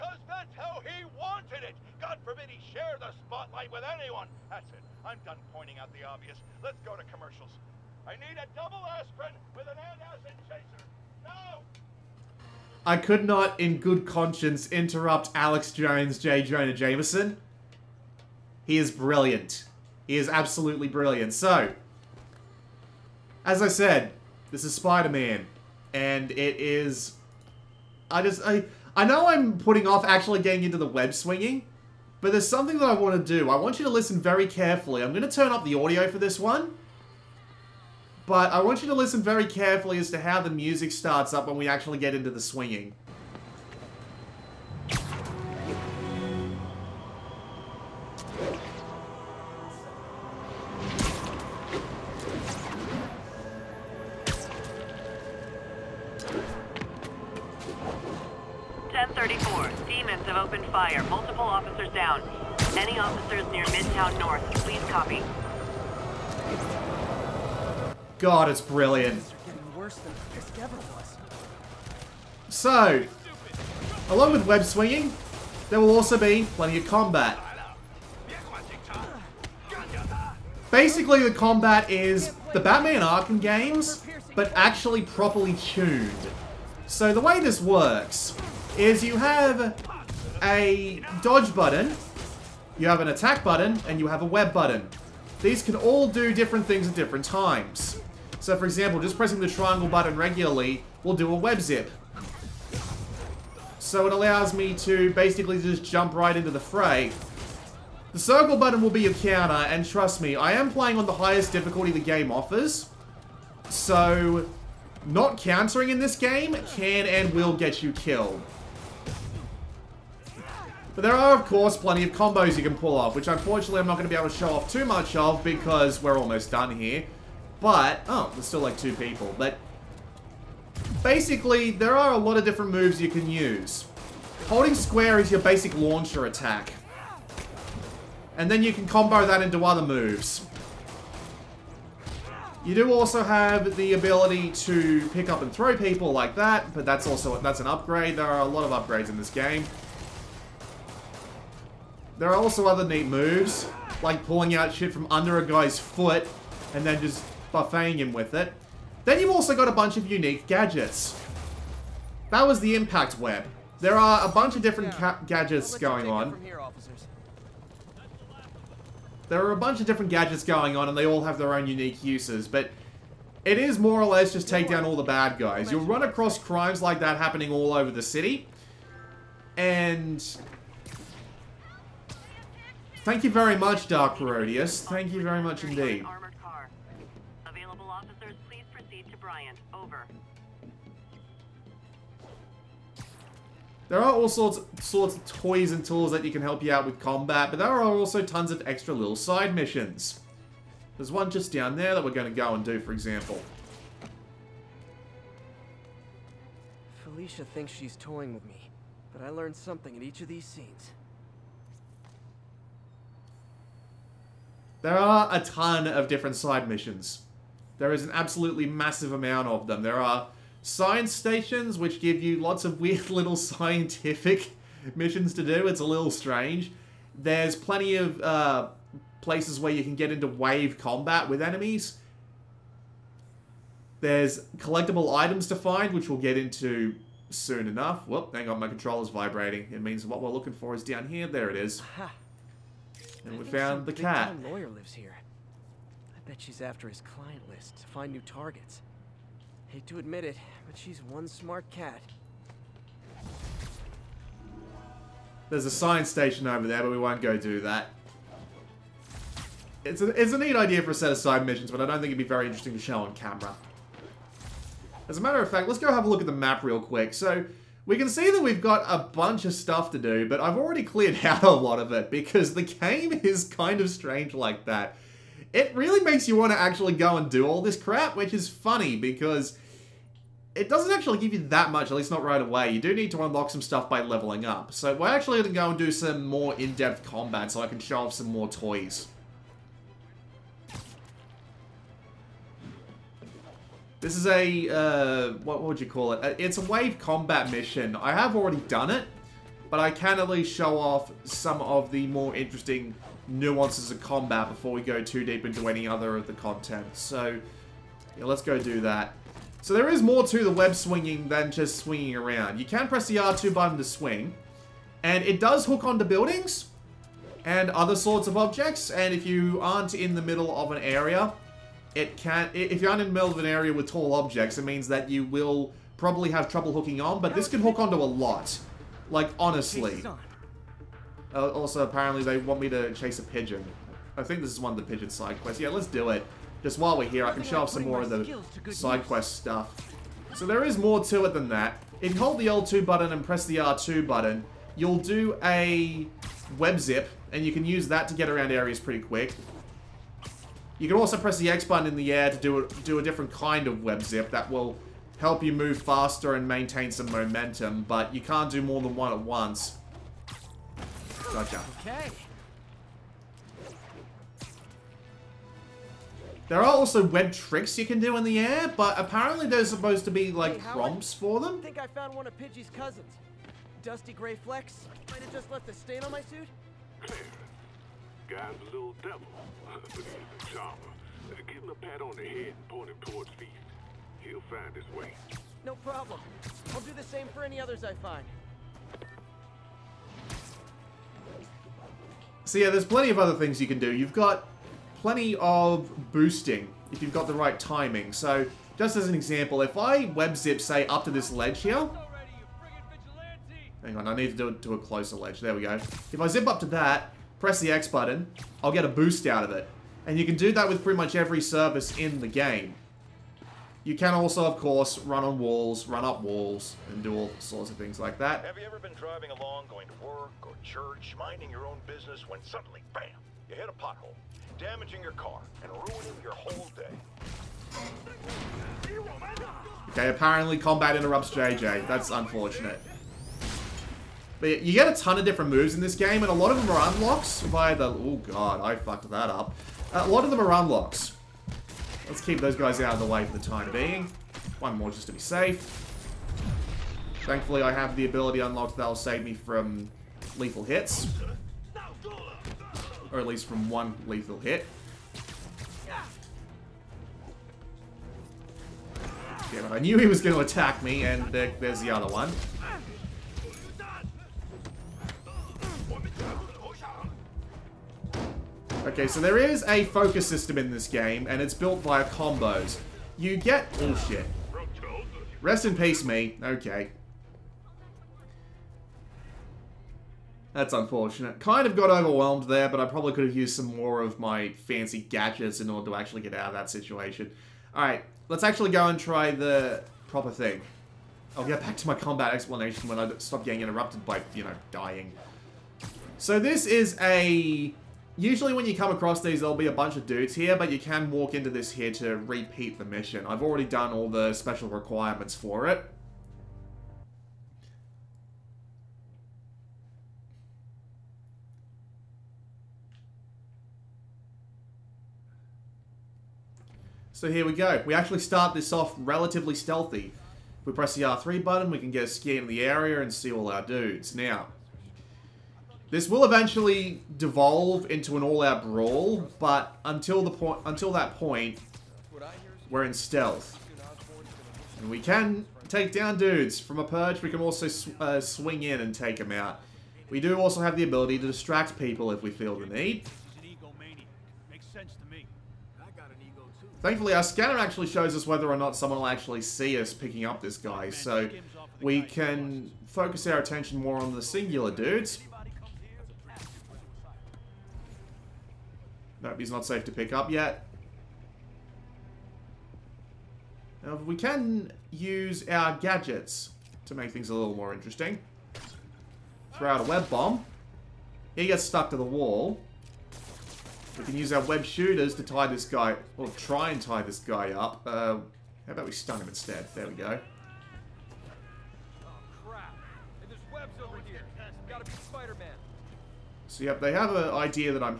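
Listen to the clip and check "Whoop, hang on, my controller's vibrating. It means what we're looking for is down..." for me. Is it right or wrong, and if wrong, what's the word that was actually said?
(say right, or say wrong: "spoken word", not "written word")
right.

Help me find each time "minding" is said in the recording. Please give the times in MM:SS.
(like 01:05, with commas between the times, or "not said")
07:01.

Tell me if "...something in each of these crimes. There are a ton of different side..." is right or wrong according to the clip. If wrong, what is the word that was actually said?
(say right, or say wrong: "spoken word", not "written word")
wrong: "scenes", not "crimes".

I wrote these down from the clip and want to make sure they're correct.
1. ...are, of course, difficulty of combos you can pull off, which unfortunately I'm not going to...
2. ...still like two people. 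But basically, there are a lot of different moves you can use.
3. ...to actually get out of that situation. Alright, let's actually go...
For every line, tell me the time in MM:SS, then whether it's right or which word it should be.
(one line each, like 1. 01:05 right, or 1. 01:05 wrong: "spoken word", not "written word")
1. 02:01 wrong: "plenty", not "difficulty"
2. 02:08 right
3. 08:05 right.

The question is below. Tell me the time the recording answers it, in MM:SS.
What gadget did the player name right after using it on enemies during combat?
02:42.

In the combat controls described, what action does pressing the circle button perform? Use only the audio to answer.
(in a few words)
Counter.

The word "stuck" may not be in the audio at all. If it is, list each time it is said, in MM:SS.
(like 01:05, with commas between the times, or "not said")
09:31.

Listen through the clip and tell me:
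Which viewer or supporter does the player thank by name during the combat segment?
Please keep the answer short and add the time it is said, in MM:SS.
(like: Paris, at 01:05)
Dark Herodias, at 03:03.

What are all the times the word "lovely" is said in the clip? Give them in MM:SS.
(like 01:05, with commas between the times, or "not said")
not said.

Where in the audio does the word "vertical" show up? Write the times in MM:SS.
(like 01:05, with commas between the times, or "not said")
not said.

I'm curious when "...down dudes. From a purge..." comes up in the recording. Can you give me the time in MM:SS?
08:55.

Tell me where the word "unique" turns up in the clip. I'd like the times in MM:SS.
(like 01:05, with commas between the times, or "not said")
02:40, 02:51.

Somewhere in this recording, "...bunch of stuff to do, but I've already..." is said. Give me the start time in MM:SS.
04:29.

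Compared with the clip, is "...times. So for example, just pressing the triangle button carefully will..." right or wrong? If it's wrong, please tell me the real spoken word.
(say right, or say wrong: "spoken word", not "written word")
wrong: "regularly", not "carefully".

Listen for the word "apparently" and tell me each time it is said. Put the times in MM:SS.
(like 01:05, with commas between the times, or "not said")
05:31, 06:08, 07:10.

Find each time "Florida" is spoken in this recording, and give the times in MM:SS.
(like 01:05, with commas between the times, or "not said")
not said.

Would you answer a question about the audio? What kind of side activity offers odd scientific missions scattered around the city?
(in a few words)
Science stations.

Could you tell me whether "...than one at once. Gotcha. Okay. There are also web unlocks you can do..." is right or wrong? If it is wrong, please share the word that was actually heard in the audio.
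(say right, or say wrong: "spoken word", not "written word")
wrong: "tricks", not "unlocks".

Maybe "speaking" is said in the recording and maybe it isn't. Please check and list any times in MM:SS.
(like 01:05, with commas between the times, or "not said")
not said.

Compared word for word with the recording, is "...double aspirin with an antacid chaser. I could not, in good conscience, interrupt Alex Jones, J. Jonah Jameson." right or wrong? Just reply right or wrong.
right.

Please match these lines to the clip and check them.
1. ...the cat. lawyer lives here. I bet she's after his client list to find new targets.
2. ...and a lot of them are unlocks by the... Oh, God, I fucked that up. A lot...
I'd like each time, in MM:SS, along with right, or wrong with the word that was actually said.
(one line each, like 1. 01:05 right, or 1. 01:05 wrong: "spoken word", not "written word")
1. 04:03 right
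2. 07:16 right.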